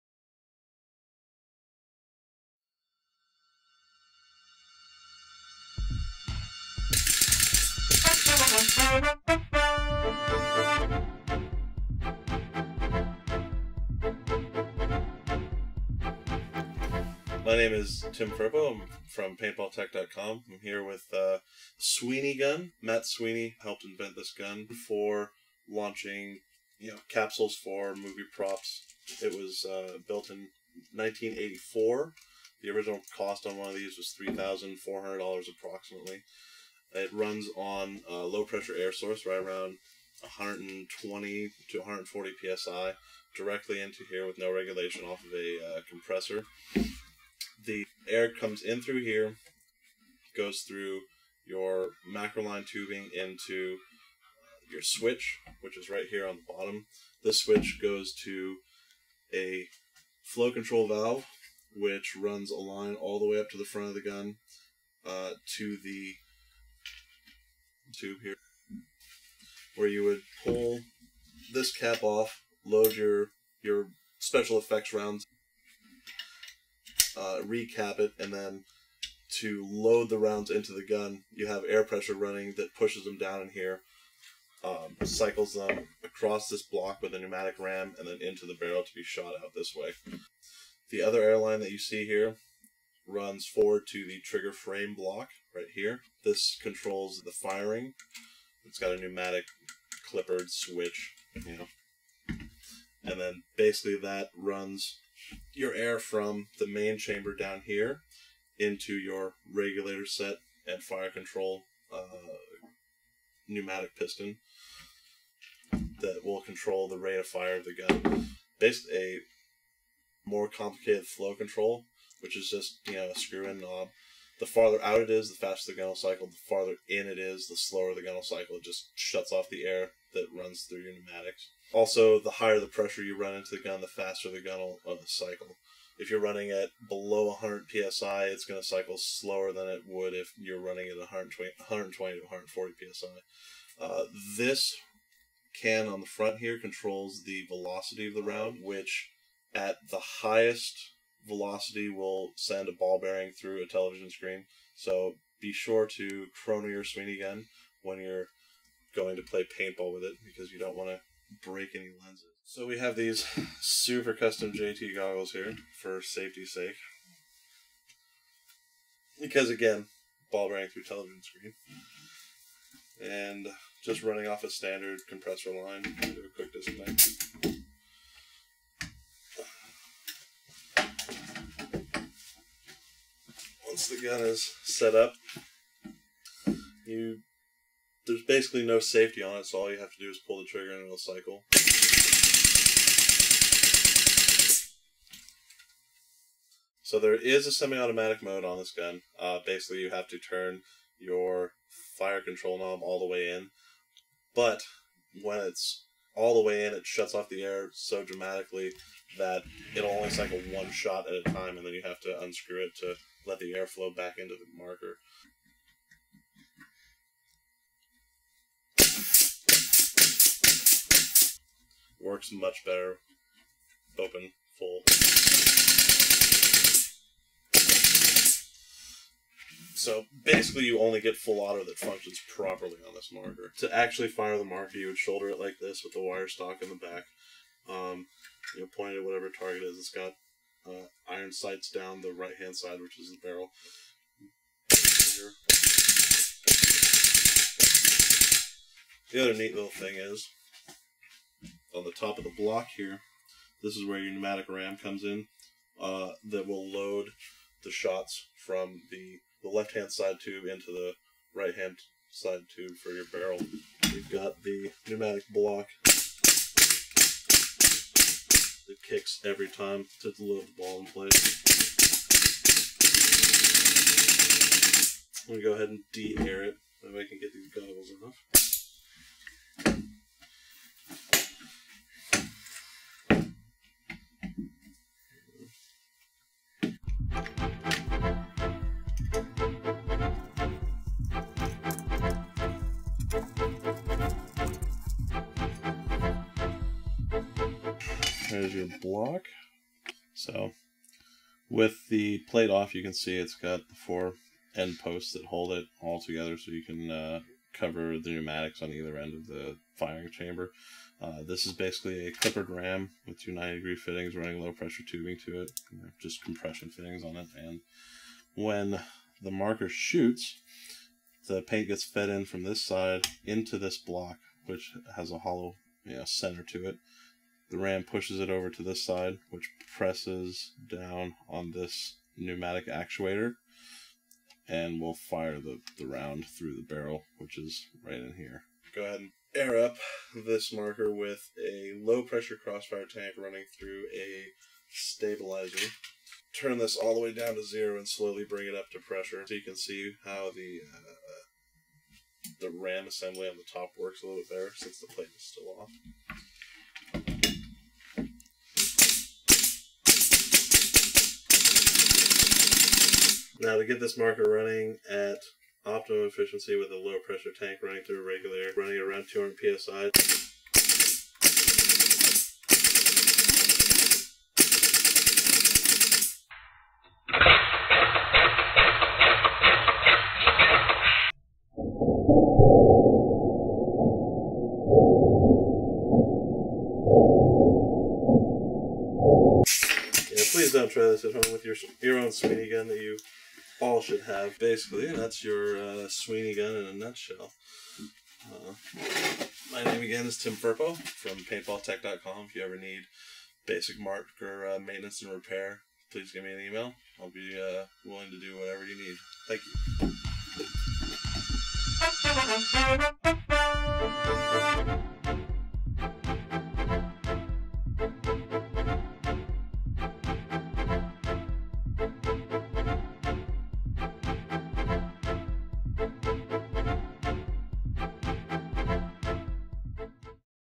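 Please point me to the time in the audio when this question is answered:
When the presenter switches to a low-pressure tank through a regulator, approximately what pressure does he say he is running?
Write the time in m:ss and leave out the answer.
6:09.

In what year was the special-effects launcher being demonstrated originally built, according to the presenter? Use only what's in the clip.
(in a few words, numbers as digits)
1984.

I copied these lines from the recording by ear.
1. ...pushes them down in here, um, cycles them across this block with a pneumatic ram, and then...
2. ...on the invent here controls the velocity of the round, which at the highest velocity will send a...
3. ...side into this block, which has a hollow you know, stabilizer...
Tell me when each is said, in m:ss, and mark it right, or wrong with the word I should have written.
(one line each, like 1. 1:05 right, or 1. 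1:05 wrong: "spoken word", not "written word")
1. 1:22 right
2. 2:25 wrong: "front", not "invent"
3. 5:22 wrong: "center", not "stabilizer".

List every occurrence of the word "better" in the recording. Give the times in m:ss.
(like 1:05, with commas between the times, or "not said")
3:42, 5:54.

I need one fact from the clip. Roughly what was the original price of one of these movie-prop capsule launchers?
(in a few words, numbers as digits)
$3,400.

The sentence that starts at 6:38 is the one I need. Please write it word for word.
Uh, my name again is Tim Firpo from paintballtek.com.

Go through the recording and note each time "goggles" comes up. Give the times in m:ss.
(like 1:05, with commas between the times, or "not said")
2:44, 4:37.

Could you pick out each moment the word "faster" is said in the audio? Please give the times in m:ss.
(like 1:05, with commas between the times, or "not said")
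2:05, 2:13.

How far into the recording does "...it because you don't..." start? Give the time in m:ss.
2:40.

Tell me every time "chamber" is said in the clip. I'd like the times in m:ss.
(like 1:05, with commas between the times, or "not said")
1:46, 5:10.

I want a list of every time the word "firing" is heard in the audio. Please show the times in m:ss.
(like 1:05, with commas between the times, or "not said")
1:37, 5:09.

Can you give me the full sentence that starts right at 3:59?
It's got uh, iron sights down the right hand side, which is the barrel.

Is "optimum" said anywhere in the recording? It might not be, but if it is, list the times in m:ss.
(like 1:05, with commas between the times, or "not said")
6:05.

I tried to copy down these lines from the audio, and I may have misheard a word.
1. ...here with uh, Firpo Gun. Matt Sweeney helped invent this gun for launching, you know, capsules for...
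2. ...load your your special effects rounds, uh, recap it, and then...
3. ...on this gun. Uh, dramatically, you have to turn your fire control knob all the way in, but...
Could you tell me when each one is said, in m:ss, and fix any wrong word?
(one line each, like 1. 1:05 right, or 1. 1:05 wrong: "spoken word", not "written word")
1. 0:20 wrong: "Sweeney", not "Firpo"
2. 1:12 right
3. 3:18 wrong: "basically", not "dramatically".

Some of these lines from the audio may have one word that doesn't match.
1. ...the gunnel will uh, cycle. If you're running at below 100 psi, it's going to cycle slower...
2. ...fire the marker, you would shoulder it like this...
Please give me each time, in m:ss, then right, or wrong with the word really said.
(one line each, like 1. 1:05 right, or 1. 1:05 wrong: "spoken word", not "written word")
1. 2:14 right
2. 3:54 right.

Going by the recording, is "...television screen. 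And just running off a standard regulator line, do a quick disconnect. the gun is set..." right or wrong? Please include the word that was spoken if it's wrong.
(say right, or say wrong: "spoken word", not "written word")
wrong: "compressor", not "regulator".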